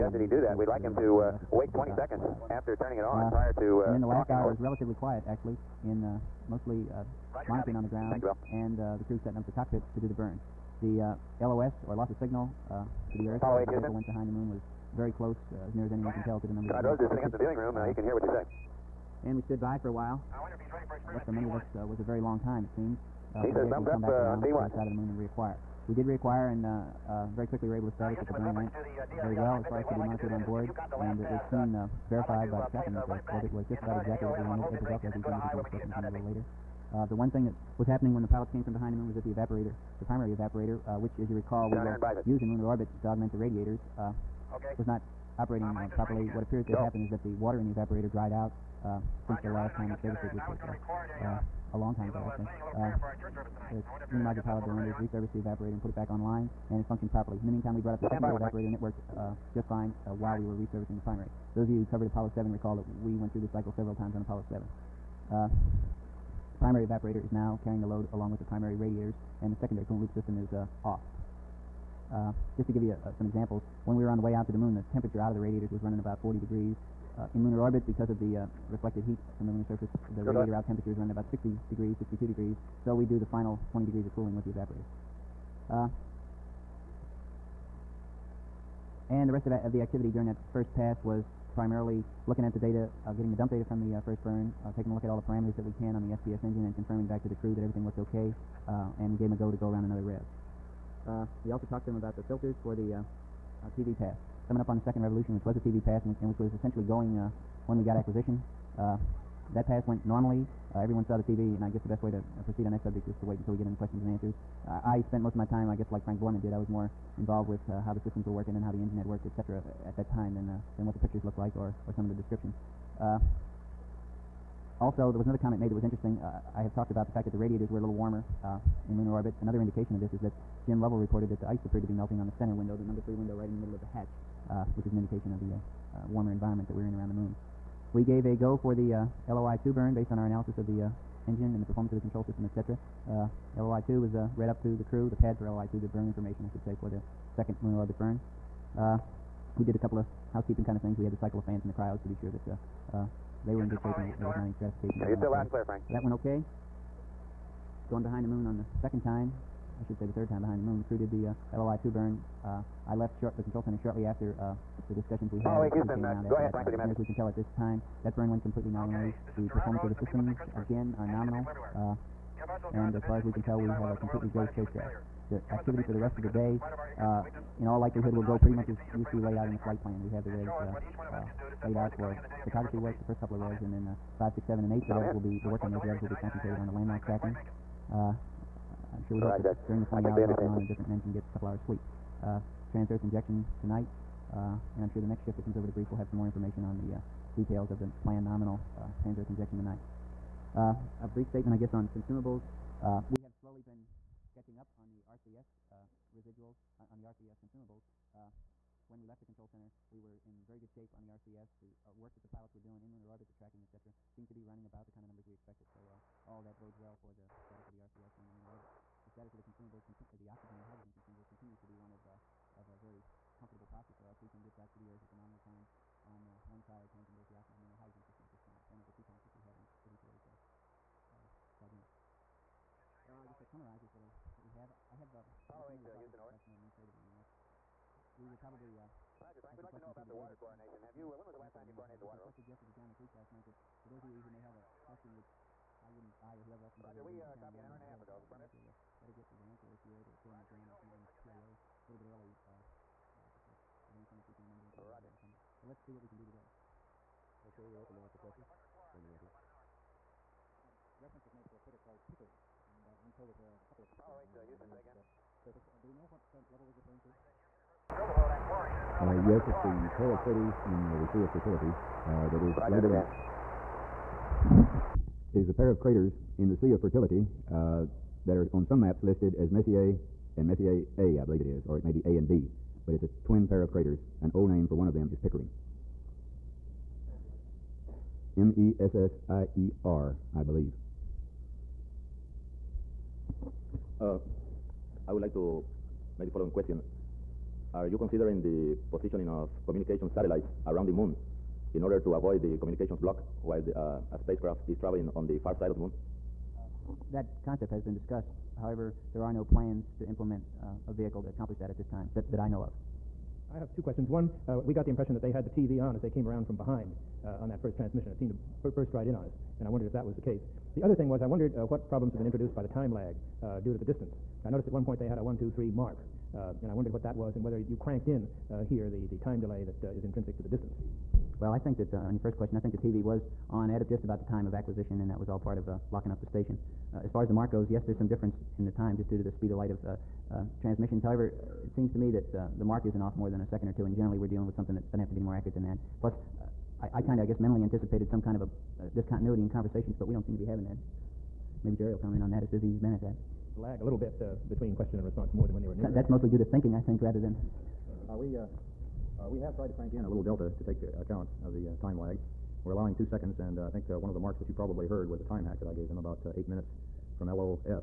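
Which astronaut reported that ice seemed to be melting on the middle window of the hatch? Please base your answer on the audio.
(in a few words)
Jim Lovell.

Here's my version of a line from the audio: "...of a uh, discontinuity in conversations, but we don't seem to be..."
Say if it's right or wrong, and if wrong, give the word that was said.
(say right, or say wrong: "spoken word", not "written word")
right.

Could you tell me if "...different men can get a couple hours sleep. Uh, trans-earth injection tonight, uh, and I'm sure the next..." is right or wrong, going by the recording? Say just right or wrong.
right.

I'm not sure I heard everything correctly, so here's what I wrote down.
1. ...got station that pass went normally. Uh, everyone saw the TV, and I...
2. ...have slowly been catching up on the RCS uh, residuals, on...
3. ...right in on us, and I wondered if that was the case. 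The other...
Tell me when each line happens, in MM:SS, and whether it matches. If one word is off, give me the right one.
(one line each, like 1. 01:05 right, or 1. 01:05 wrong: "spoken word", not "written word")
1. 01:47 wrong: "acquisition", not "station"
2. 03:23 right
3. 05:18 right.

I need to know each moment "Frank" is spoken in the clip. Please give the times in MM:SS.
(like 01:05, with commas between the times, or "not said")
01:56, 02:35, 02:46, 03:59.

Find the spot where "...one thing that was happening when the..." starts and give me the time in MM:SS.
00:37.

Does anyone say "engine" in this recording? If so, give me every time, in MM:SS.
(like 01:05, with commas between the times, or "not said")
01:36, 01:58, 02:21.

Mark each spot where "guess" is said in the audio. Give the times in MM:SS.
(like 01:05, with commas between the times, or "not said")
01:51, 01:55, 03:21, 03:53, 05:47.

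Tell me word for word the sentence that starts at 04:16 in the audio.
I'm sure we're open to lots of questions.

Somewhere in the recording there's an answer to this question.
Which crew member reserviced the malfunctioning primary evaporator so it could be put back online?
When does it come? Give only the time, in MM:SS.
00:54.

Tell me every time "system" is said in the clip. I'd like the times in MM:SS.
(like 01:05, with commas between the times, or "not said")
01:10, 01:58, 02:22, 02:50, 03:48.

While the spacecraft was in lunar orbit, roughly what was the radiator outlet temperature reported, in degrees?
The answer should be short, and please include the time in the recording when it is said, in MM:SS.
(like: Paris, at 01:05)
62, at 01:22.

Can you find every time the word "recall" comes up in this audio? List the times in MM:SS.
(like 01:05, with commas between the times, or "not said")
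00:41, 01:02.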